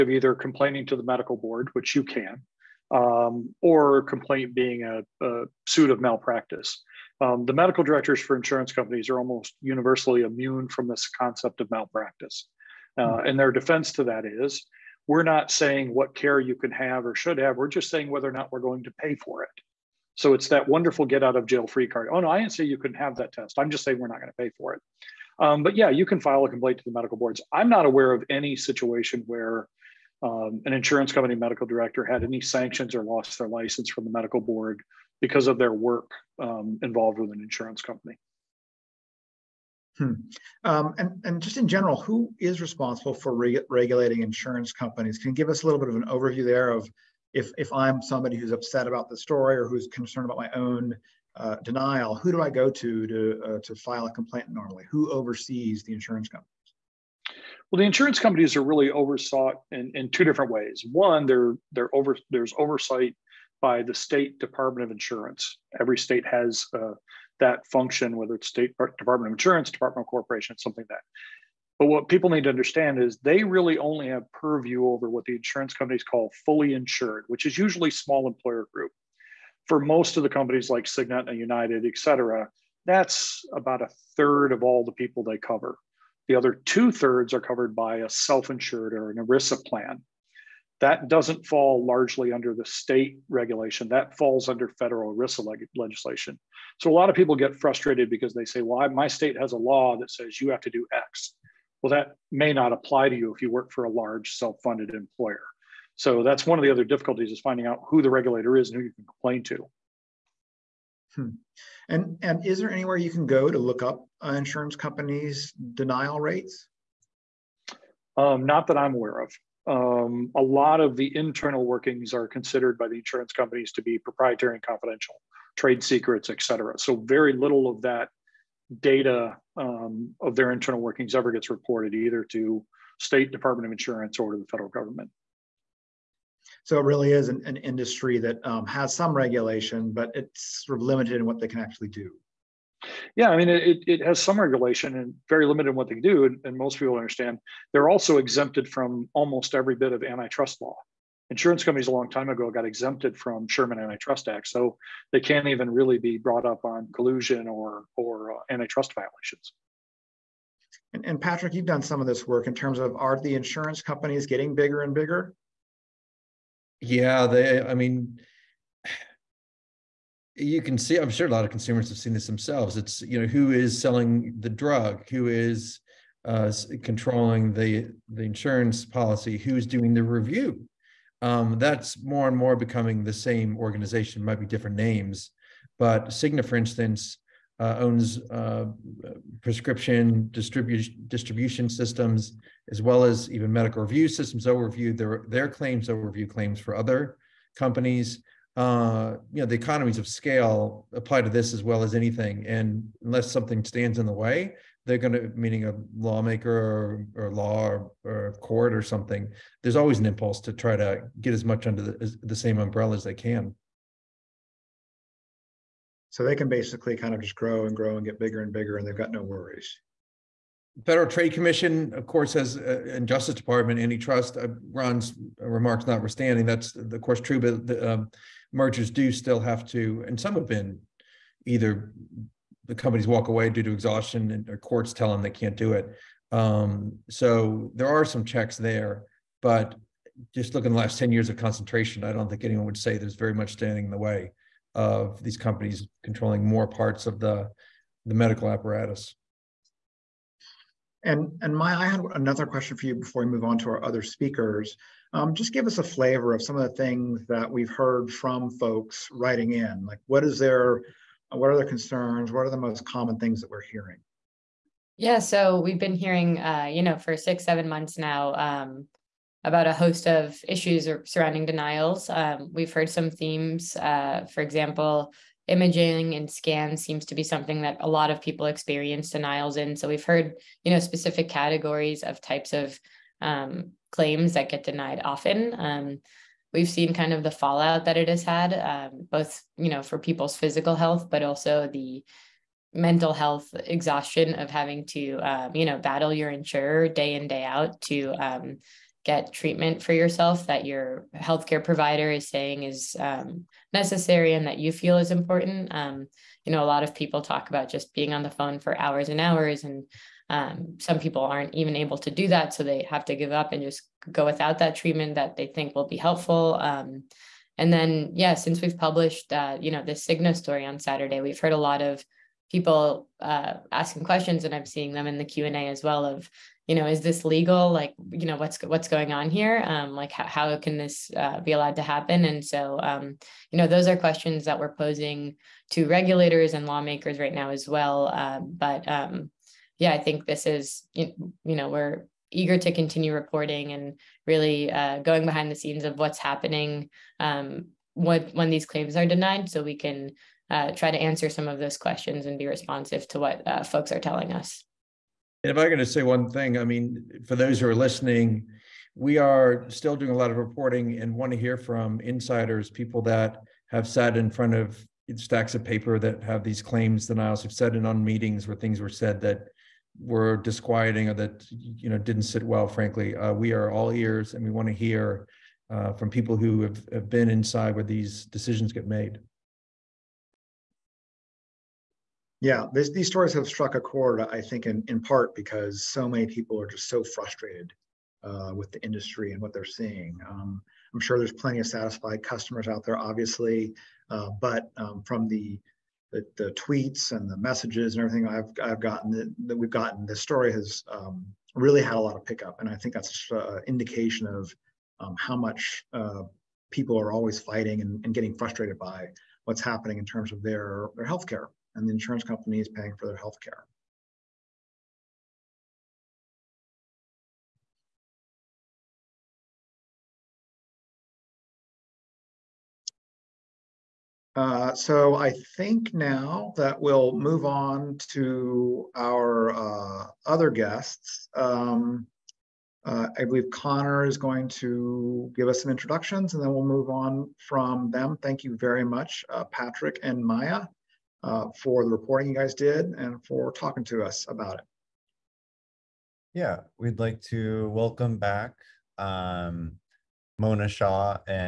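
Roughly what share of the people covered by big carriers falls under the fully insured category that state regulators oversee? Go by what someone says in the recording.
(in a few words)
a third.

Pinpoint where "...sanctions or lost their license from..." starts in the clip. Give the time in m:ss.
0:32.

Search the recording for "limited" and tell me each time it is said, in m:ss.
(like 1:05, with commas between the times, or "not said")
2:20, 2:25.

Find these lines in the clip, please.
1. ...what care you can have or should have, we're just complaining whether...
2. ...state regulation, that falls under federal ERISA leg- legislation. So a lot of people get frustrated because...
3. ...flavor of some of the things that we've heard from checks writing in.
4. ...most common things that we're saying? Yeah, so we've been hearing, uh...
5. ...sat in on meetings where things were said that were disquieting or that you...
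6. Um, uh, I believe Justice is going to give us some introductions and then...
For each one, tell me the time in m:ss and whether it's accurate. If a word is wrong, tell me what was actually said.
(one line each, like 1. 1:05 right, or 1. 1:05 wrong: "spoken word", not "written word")
1. 0:15 wrong: "saying", not "complaining"
2. 1:32 right
3. 4:15 wrong: "folks", not "checks"
4. 4:22 wrong: "hearing", not "saying"
5. 6:07 right
6. 7:11 wrong: "Connor", not "Justice".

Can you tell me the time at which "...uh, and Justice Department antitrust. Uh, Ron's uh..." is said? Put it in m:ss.
3:42.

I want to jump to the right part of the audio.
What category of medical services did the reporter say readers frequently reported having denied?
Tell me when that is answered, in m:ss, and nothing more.
4:35.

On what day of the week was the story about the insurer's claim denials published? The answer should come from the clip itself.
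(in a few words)
Saturday.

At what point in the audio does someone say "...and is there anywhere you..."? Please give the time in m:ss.
1:52.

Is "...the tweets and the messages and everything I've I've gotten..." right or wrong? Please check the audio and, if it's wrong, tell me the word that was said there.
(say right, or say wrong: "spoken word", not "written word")
right.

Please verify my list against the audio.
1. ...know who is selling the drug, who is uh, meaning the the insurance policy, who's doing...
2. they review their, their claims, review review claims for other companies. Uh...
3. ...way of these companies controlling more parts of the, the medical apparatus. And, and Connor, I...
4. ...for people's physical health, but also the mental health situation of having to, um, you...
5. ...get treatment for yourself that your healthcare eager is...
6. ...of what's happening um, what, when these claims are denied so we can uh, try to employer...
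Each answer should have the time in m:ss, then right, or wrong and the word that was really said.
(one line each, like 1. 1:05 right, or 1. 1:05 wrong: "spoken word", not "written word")
1. 2:53 wrong: "controlling", not "meaning"
2. 3:14 wrong: "overview", not "review"
3. 4:03 wrong: "Maya", not "Connor"
4. 4:49 wrong: "exhaustion", not "situation"
5. 4:59 wrong: "provider", not "eager"
6. 5:45 wrong: "answer", not "employer".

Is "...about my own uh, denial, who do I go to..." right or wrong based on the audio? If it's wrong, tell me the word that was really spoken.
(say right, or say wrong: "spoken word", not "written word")
right.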